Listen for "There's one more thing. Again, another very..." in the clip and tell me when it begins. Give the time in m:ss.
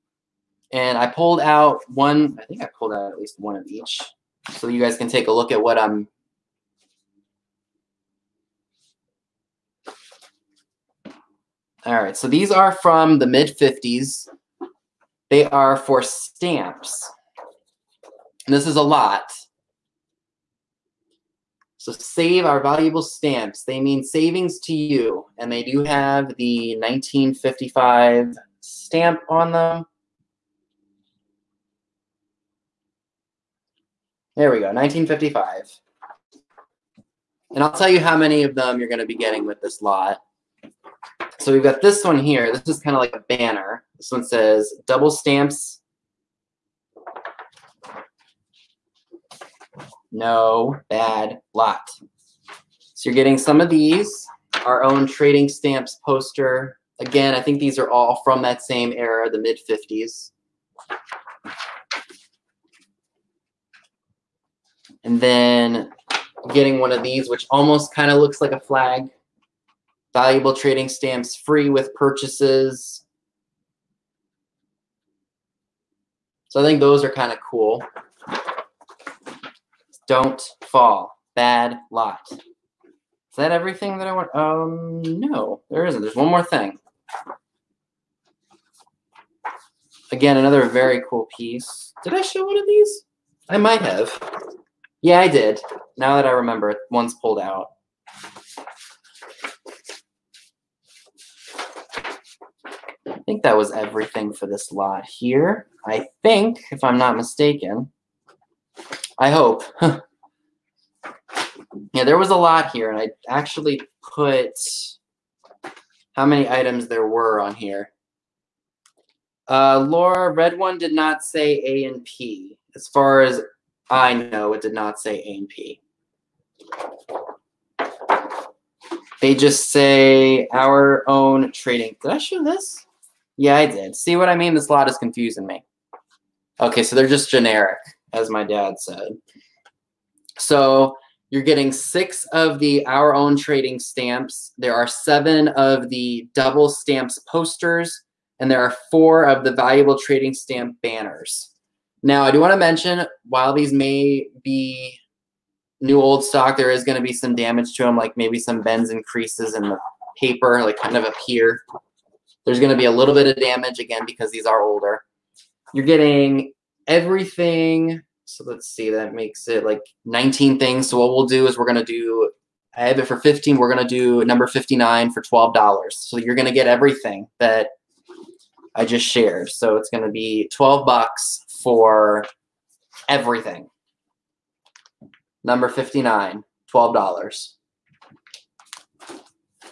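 1:25.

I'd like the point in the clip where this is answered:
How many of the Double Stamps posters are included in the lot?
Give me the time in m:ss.
2:24.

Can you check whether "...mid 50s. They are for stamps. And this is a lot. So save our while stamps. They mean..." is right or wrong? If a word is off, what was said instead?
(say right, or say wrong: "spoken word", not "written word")
wrong: "valuable", not "while".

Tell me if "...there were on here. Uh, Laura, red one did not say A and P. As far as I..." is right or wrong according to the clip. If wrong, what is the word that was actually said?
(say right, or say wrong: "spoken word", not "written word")
right.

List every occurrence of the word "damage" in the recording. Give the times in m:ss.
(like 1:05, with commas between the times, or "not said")
2:37, 2:43.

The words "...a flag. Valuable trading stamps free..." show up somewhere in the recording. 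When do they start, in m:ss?
1:08.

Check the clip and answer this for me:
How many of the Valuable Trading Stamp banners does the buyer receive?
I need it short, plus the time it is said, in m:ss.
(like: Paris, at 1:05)
4, at 2:28.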